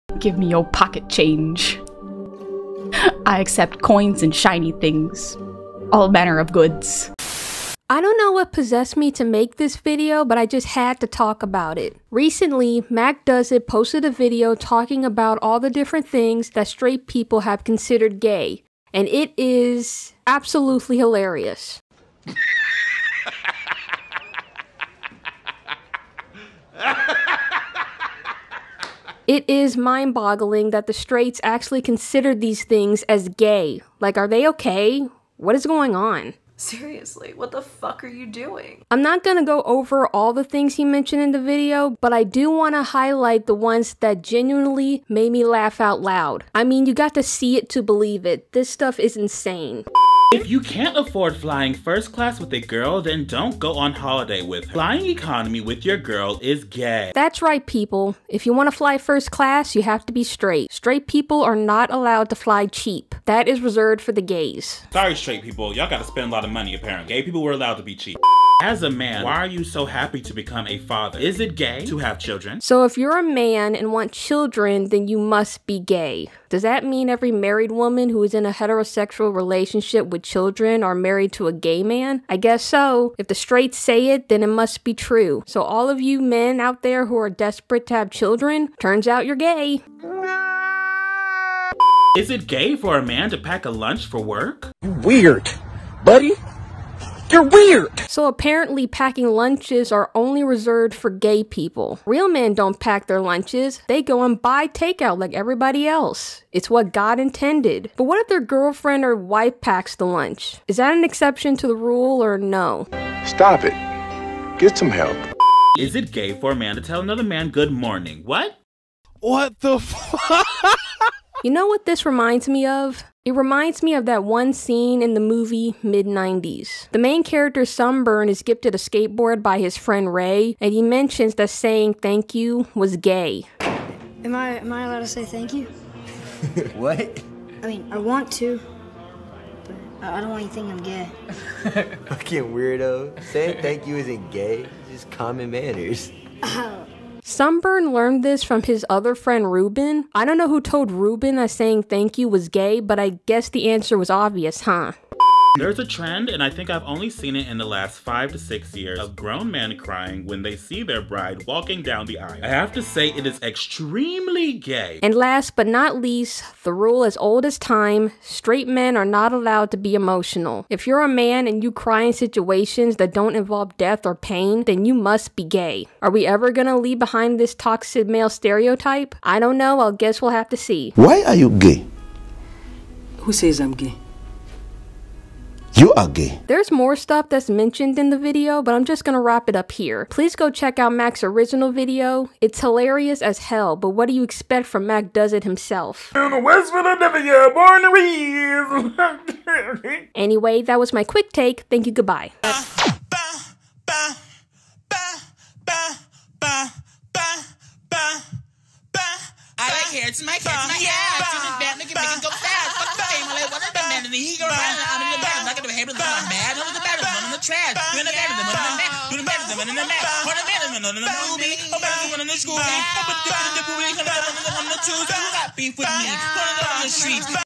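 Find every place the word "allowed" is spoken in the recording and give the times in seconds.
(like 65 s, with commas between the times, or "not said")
61 s, 67 s, 134 s, 169 s.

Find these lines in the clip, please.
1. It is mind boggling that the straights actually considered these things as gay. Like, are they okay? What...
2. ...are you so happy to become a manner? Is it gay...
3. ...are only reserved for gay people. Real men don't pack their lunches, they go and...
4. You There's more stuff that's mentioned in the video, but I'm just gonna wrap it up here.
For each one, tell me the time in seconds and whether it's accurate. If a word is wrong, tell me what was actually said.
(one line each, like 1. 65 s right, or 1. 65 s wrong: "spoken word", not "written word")
1. 29 s right
2. 69 s wrong: "father", not "manner"
3. 99 s right
4. 185 s right.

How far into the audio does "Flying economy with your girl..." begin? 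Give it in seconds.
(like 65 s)
54 s.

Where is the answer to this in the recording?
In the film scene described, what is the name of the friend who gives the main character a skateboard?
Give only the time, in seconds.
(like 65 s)
130 s.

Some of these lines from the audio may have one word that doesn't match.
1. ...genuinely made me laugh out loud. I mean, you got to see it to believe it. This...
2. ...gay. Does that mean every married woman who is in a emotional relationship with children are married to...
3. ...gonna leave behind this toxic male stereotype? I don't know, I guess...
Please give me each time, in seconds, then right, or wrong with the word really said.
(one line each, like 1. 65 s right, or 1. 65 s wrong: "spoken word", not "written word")
1. 44 s right
2. 75 s wrong: "heterosexual", not "emotional"
3. 176 s right.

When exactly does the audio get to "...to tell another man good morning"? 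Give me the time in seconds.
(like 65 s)
116 s.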